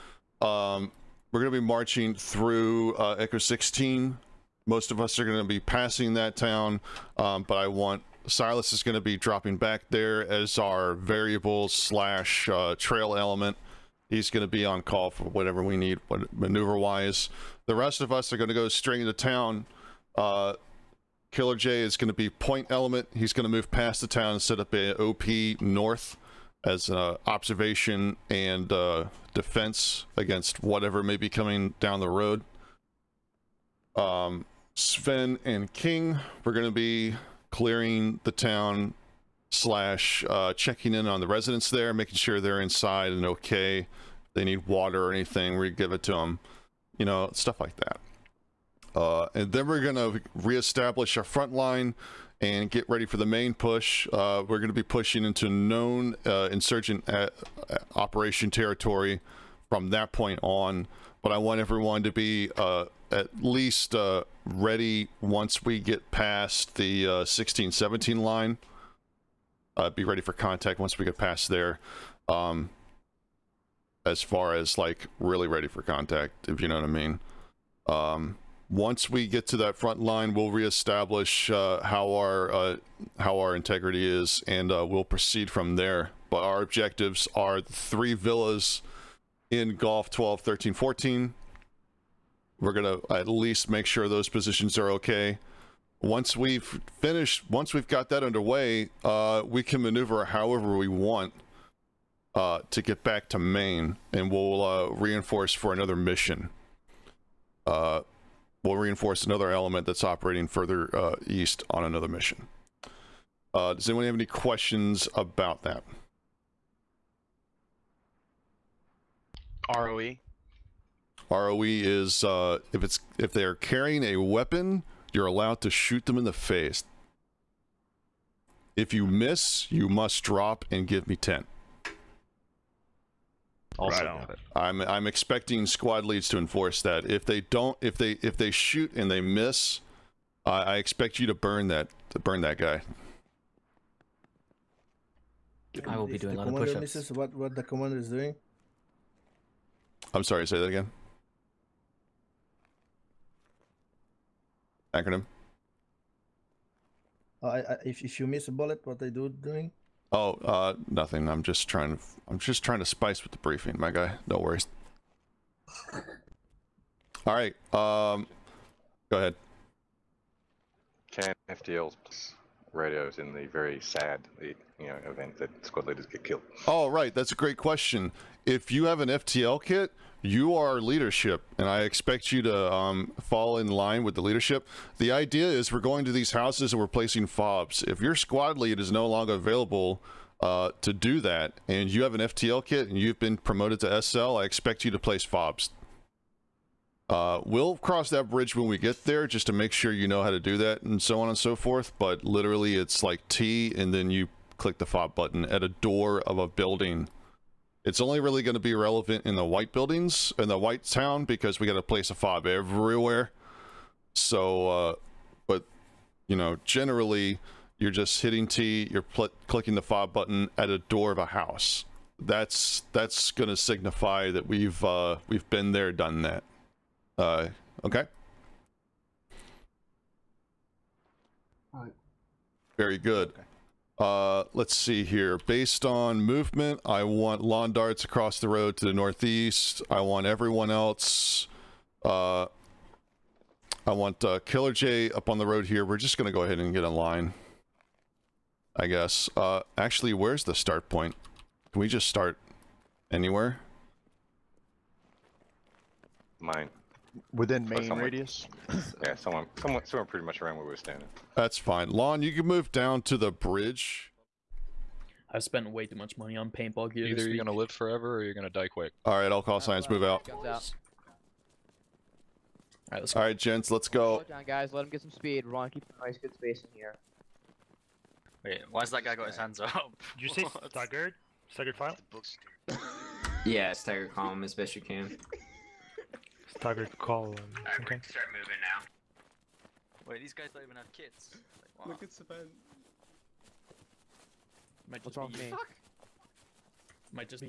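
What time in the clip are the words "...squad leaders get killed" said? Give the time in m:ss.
2:55.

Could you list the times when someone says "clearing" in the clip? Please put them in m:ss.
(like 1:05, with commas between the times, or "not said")
0:37.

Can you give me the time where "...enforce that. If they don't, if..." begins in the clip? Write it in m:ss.
2:16.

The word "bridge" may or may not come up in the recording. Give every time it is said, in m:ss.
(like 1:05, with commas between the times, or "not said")
3:18, 4:23.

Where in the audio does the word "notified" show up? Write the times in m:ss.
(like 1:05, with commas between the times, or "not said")
not said.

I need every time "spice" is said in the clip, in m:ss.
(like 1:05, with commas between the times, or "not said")
2:42.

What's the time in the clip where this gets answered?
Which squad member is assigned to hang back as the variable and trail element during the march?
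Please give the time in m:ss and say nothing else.
0:08.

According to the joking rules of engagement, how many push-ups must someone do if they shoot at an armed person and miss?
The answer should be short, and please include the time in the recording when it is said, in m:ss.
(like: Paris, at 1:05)
10, at 2:11.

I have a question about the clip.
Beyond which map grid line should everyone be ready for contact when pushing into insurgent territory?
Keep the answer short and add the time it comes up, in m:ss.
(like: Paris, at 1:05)
16-17 line, at 1:07.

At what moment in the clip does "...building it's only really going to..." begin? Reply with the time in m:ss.
3:26.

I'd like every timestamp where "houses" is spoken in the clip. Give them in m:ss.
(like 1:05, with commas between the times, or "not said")
3:06, 3:41.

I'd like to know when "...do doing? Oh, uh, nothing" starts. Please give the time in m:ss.
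2:39.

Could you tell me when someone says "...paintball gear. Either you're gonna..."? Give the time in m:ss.
4:26.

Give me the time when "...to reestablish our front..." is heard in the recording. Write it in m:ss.
0:49.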